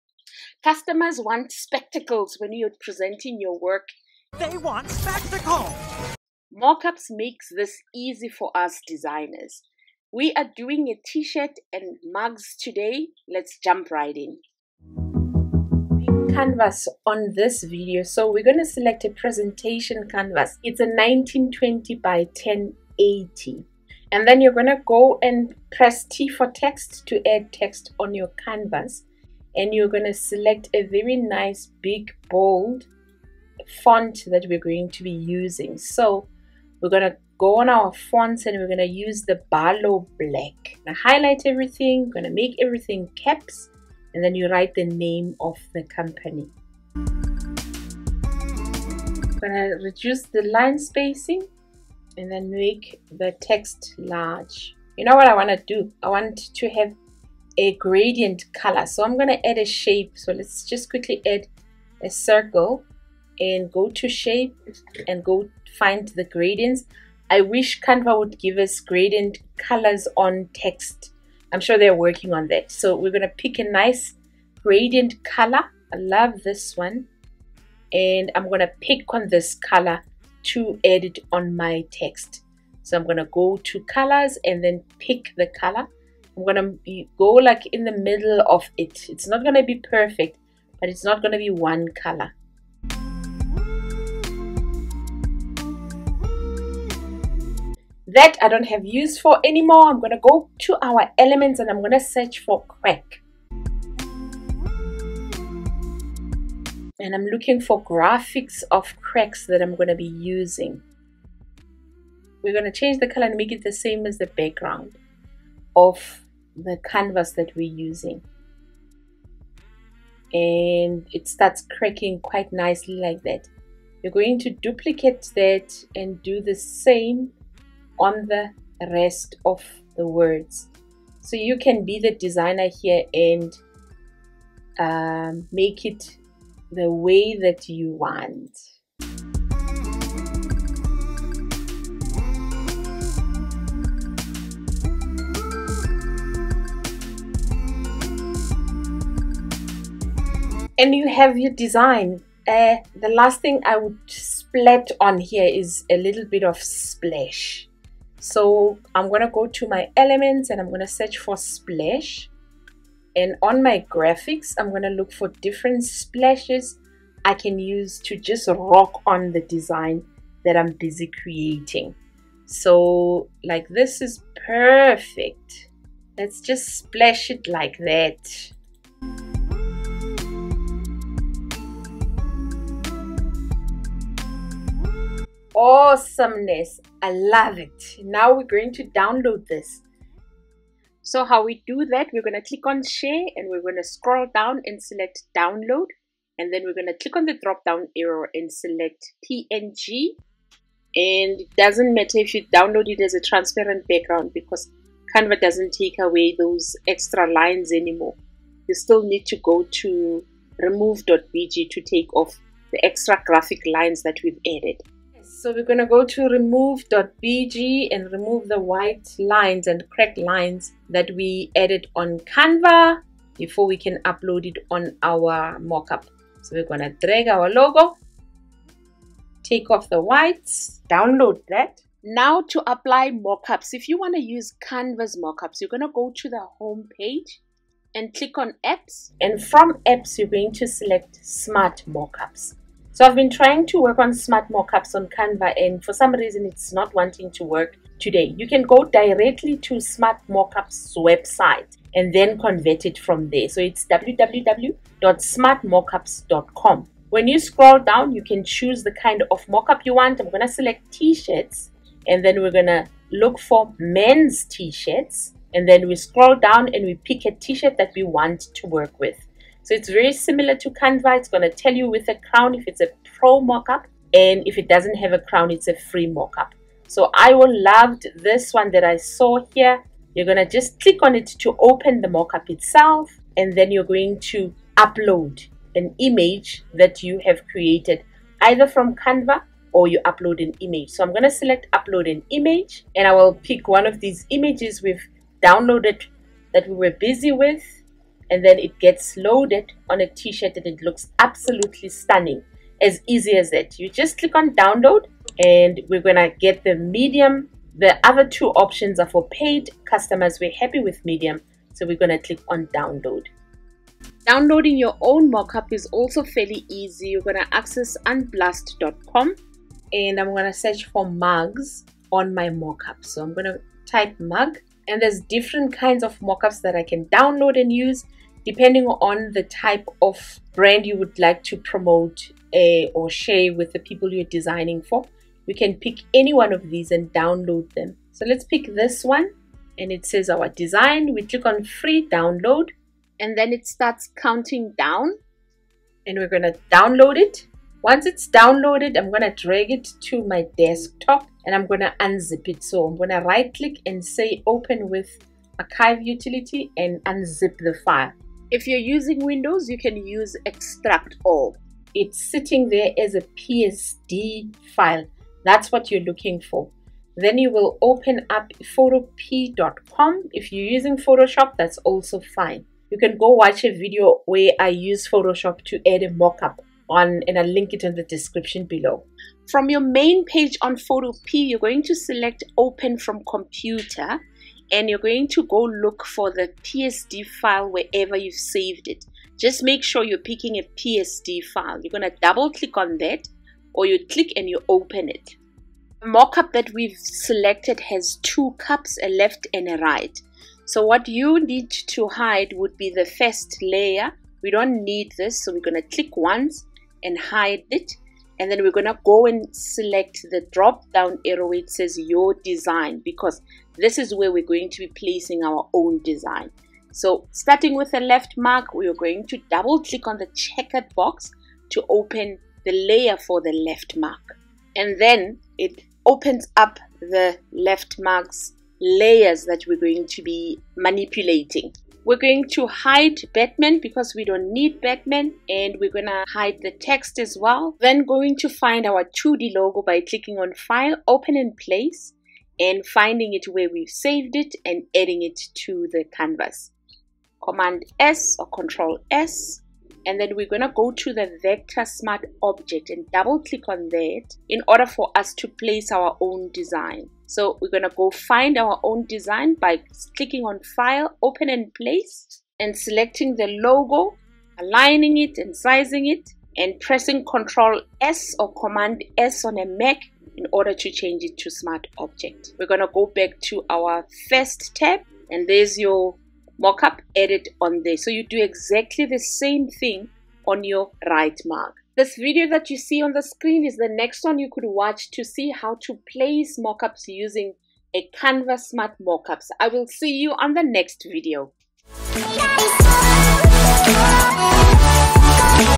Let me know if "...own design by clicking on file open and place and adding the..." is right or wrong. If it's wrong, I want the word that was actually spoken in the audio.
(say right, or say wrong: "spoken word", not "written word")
wrong: "selecting", not "adding".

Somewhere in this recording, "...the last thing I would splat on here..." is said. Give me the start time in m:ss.
2:32.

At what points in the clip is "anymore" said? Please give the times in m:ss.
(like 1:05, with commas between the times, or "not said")
1:39, 3:27.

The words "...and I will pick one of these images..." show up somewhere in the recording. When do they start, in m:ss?
4:52.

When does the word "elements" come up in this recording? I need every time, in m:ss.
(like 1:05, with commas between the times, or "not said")
1:41, 2:39.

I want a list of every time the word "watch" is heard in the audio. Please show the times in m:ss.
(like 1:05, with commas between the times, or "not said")
6:13, 8:04.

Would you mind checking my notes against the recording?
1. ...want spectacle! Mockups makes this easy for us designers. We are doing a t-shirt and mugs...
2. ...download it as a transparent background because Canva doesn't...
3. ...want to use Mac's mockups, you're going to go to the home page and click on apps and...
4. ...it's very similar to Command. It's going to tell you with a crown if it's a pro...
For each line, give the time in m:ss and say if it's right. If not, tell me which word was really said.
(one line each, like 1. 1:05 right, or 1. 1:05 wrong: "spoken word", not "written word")
1. 0:04 right
2. 3:22 right
3. 3:53 wrong: "Canva", not "Mac"
4. 4:29 wrong: "Canva", not "Command".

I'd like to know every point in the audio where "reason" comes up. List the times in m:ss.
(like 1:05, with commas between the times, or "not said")
4:06.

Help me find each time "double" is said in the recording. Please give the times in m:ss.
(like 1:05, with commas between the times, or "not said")
6:32, 6:59, 7:33.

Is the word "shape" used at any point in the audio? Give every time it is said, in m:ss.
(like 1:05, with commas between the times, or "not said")
0:59, 1:04.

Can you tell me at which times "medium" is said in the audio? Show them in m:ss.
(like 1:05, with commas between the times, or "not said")
5:06, 5:11.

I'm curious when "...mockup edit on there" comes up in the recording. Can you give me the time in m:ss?
7:56.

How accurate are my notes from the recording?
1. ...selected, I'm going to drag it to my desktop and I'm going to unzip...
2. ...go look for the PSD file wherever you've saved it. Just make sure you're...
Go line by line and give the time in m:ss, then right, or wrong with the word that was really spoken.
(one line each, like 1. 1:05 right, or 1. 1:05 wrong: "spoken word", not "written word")
1. 5:48 wrong: "downloaded", not "selected"
2. 6:25 right.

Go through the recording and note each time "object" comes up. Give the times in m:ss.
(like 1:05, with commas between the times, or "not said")
7:32, 7:51.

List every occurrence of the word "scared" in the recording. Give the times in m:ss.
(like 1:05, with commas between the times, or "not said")
not said.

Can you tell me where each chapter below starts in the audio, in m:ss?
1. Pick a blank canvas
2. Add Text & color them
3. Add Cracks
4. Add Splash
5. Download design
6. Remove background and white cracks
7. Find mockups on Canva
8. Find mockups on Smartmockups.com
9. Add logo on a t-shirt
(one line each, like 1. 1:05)
1. 0:17
2. 0:28
3. 1:41
4. 2:44
5. 3:20
6. 3:37
7. 3:58
8. 4:11
9. 4:24.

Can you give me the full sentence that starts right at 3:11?
So how we do that, we're going to click on share and we're going to scroll down and select download.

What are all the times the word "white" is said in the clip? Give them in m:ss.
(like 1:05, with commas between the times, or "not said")
3:38, 3:49.